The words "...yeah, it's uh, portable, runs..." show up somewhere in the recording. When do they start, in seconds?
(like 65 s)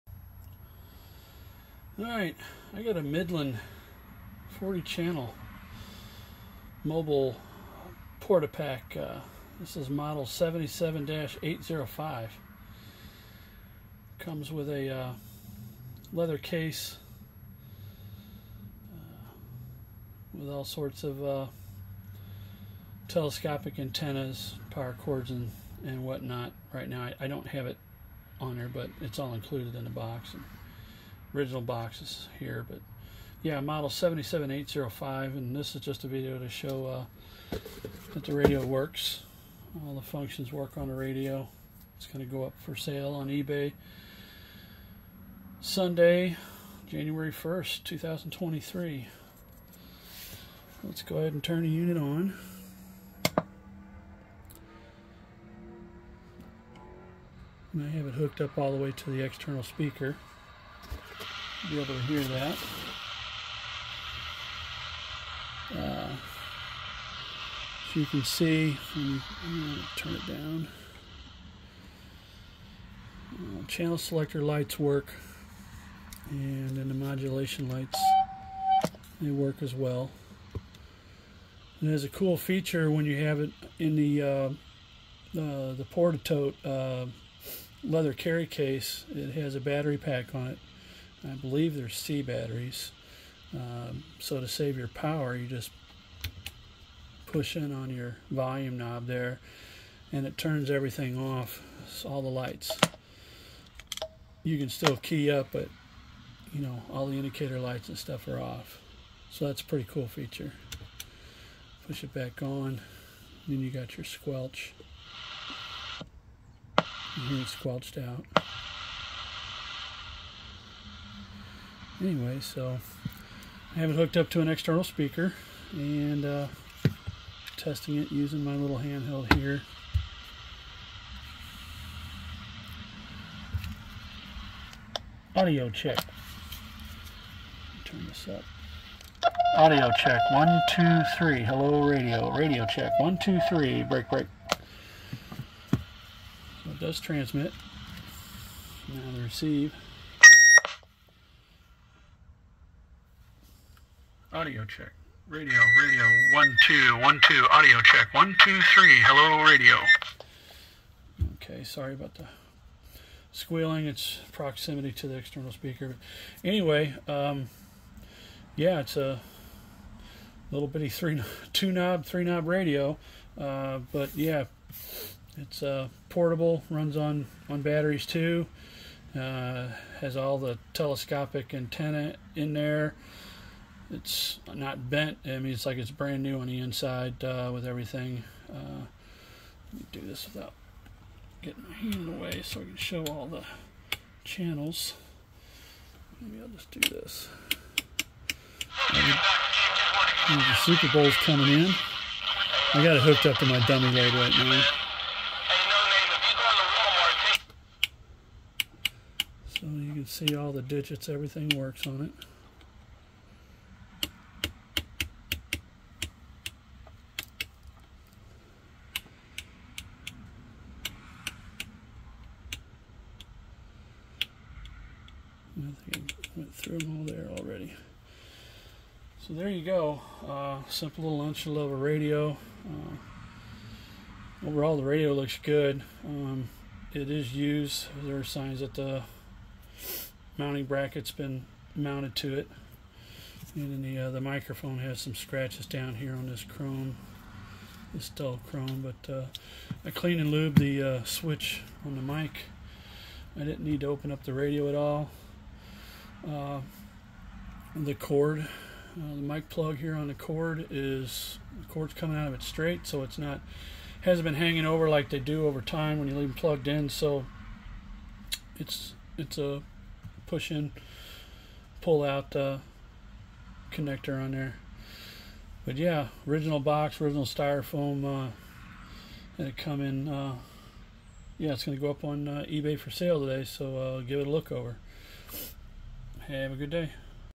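174 s.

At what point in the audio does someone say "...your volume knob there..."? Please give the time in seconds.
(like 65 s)
97 s.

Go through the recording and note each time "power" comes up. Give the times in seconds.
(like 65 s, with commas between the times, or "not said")
24 s, 94 s.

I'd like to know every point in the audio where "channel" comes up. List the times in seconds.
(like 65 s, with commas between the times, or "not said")
4 s, 73 s, 194 s.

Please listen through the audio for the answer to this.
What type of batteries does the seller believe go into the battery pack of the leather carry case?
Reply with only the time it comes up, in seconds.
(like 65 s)
91 s.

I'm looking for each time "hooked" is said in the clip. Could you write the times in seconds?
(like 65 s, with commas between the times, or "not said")
58 s, 123 s, 203 s.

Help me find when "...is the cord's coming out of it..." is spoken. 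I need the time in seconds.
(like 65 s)
260 s.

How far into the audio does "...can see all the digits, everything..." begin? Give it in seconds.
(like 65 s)
209 s.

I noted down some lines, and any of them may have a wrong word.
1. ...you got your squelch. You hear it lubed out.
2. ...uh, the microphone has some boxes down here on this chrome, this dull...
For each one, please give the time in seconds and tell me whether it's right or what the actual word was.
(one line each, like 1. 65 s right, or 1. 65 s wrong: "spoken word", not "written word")
1. 113 s wrong: "squelched", not "lubed"
2. 244 s wrong: "scratches", not "boxes".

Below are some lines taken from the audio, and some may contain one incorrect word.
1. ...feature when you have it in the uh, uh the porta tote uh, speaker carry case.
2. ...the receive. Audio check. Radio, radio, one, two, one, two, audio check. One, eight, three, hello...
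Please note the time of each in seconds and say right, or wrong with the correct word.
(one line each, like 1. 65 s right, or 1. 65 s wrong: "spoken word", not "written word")
1. 82 s wrong: "leather", not "speaker"
2. 149 s wrong: "two", not "eight".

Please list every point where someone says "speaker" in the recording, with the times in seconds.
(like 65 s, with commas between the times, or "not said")
59 s, 124 s, 165 s.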